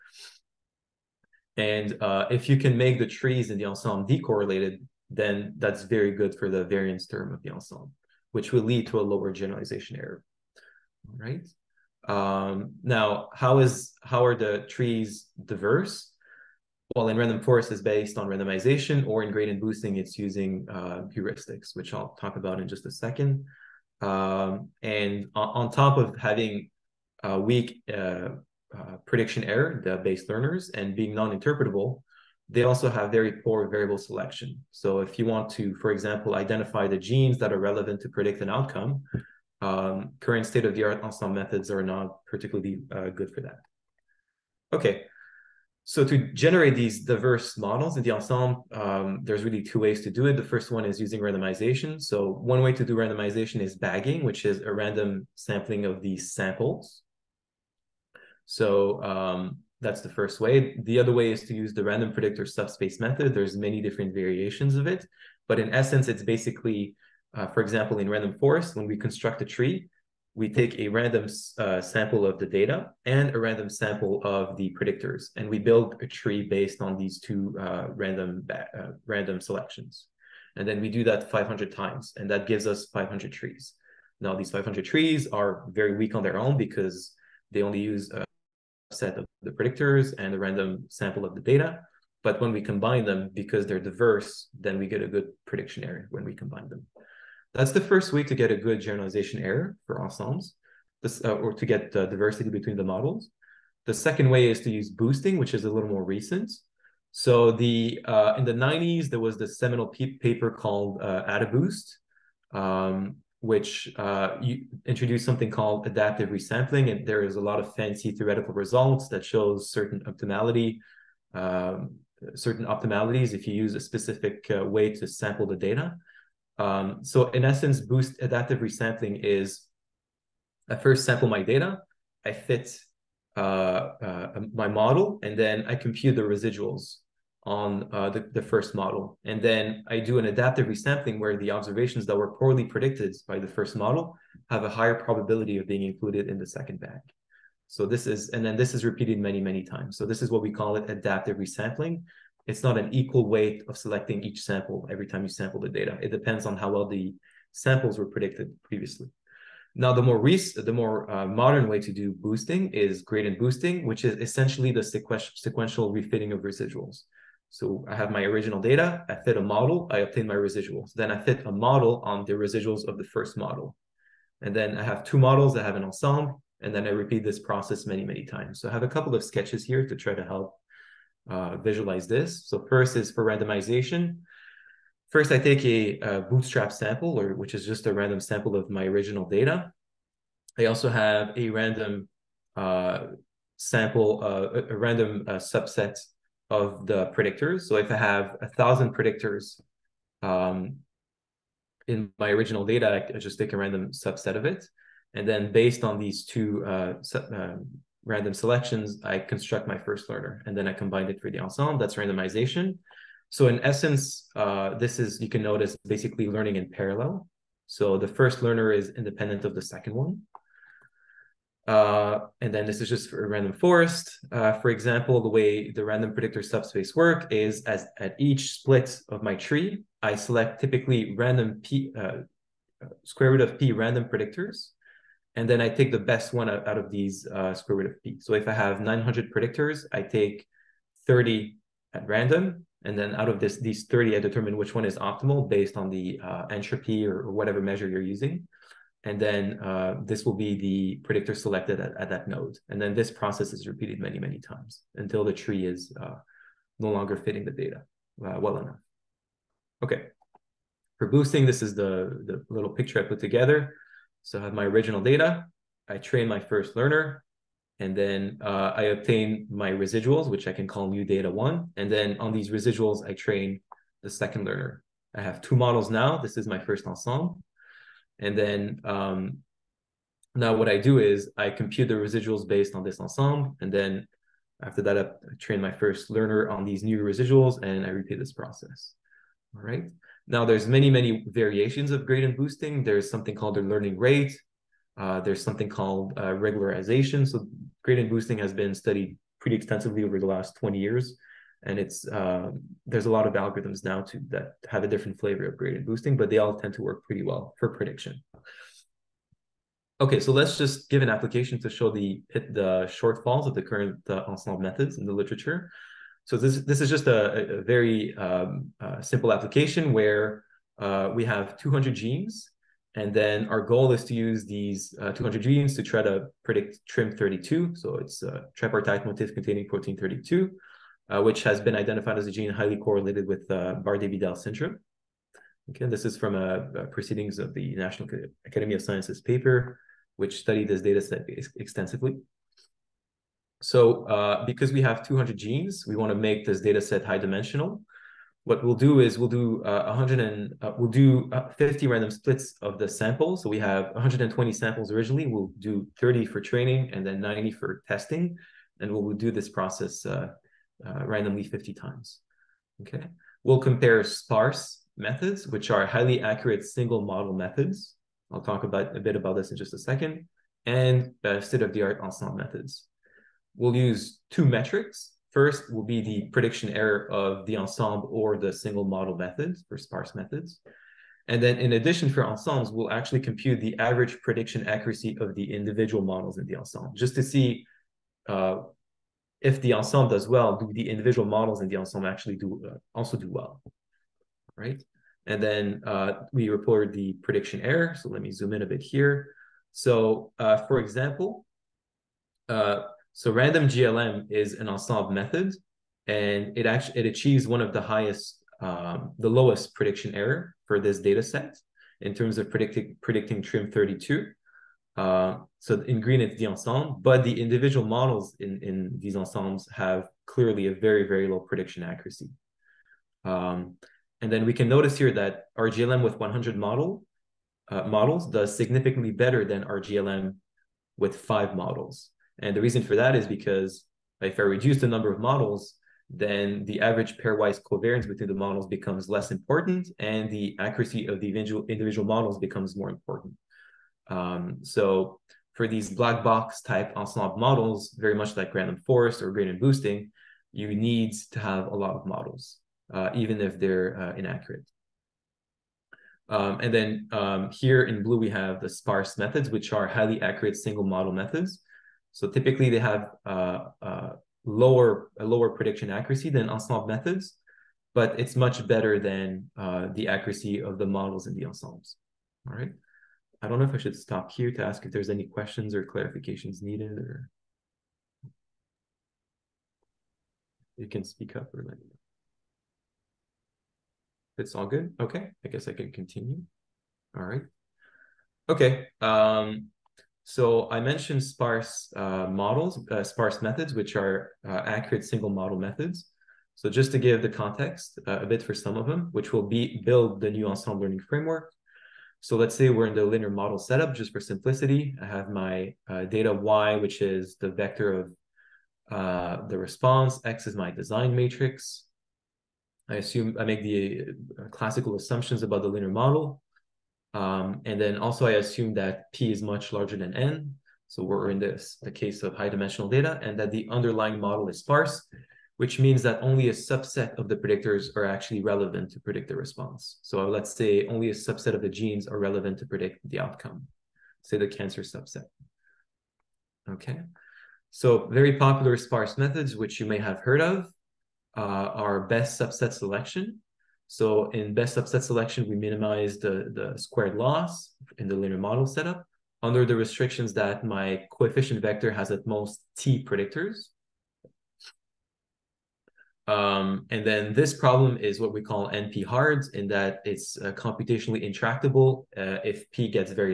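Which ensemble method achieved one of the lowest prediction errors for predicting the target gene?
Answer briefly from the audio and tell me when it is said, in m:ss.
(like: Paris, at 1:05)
random GLM, at 6:43.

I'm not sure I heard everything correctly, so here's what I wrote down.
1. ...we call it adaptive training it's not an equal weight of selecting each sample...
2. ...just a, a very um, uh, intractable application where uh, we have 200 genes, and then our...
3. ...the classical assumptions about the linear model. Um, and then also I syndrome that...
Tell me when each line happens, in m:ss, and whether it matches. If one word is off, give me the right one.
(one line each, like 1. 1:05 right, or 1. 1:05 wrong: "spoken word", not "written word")
1. 2:30 wrong: "resampling", not "training"
2. 5:16 wrong: "simple", not "intractable"
3. 8:33 wrong: "assume", not "syndrome".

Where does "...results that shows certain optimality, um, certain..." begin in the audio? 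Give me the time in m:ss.
1:58.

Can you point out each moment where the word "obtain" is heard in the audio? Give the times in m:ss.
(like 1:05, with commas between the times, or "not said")
2:49, 4:28.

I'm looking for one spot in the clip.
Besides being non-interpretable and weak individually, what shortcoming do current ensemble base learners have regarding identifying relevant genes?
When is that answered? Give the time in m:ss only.
0:33.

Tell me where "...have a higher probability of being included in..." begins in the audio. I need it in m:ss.
2:24.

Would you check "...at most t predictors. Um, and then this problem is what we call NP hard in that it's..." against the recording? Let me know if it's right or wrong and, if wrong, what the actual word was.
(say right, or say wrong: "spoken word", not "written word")
right.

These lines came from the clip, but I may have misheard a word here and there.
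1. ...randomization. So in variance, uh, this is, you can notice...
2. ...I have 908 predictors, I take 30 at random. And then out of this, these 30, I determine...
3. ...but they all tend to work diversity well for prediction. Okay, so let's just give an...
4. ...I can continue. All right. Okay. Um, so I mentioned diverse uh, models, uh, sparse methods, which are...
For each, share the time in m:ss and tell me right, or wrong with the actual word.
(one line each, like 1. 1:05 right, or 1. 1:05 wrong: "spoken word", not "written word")
1. 3:31 wrong: "essence", not "variance"
2. 3:58 wrong: "900", not "908"
3. 5:06 wrong: "pretty", not "diversity"
4. 8:05 wrong: "sparse", not "diverse".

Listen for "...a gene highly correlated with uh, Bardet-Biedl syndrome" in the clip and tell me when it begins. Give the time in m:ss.
5:32.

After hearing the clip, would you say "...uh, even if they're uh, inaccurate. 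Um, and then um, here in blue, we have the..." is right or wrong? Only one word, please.
right.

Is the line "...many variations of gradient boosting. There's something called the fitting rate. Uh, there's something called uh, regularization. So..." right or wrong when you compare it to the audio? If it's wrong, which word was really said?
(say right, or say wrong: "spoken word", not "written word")
wrong: "learning", not "fitting".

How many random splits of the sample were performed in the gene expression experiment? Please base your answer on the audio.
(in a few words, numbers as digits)
50.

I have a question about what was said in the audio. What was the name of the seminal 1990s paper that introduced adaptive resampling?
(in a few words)
AdaBoost.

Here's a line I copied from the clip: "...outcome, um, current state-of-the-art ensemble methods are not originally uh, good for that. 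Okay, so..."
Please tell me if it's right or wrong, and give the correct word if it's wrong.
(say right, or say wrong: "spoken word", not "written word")
wrong: "particularly", not "originally".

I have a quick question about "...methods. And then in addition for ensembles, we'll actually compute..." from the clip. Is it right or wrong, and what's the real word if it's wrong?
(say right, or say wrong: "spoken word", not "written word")
right.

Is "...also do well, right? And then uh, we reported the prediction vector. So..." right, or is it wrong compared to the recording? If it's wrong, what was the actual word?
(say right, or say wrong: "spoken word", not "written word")
wrong: "error", not "vector".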